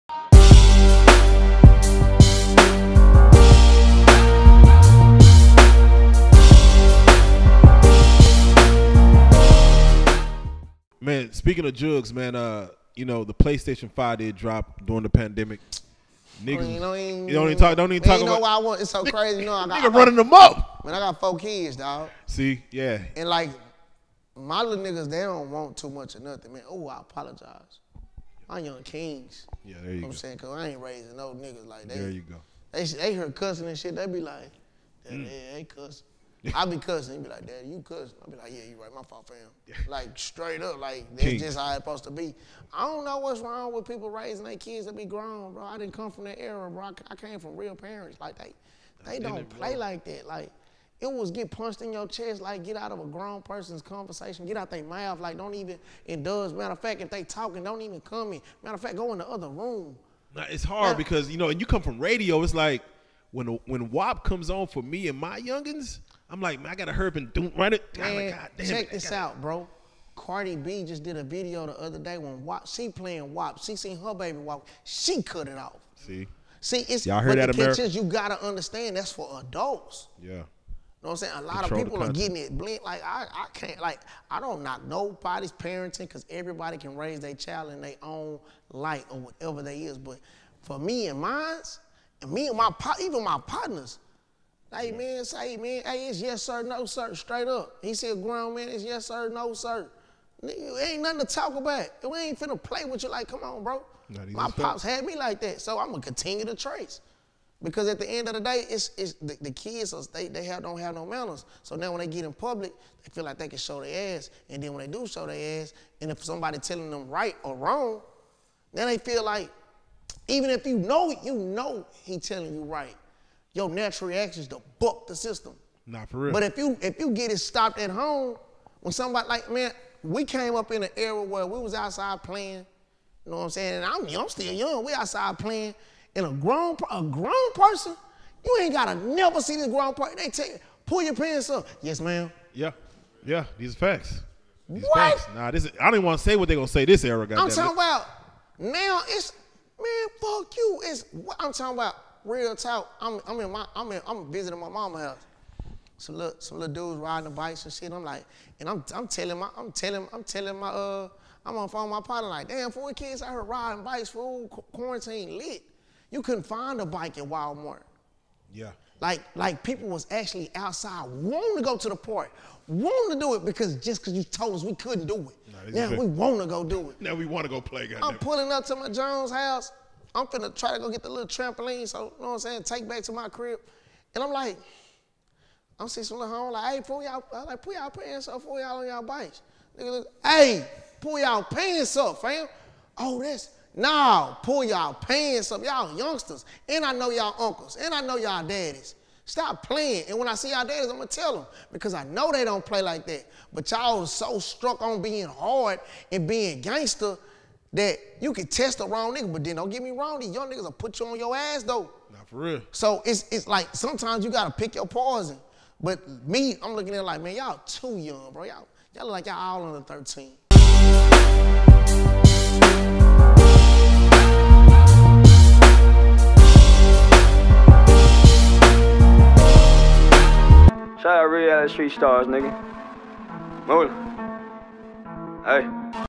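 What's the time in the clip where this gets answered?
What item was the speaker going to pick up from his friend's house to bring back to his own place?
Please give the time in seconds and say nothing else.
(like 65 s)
181 s.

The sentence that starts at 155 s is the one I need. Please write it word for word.
Some little, some little dudes riding bikes and shit.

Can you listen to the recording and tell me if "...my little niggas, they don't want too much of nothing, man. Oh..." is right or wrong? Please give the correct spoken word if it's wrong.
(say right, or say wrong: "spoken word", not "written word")
right.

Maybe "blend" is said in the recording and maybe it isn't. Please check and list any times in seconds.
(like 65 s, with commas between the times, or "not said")
82 s.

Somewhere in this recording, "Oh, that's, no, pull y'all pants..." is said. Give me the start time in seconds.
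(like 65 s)
192 s.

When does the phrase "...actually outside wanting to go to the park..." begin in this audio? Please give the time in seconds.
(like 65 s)
170 s.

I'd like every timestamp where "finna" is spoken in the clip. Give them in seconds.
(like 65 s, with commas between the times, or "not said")
102 s, 180 s.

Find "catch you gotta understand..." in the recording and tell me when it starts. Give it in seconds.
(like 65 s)
77 s.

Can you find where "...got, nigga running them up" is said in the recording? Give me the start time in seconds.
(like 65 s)
19 s.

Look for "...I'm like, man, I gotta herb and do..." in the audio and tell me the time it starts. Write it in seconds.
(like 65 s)
66 s.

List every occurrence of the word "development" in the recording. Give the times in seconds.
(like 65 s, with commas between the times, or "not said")
not said.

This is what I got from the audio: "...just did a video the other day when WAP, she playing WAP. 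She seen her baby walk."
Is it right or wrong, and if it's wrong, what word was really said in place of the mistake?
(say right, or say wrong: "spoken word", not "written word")
right.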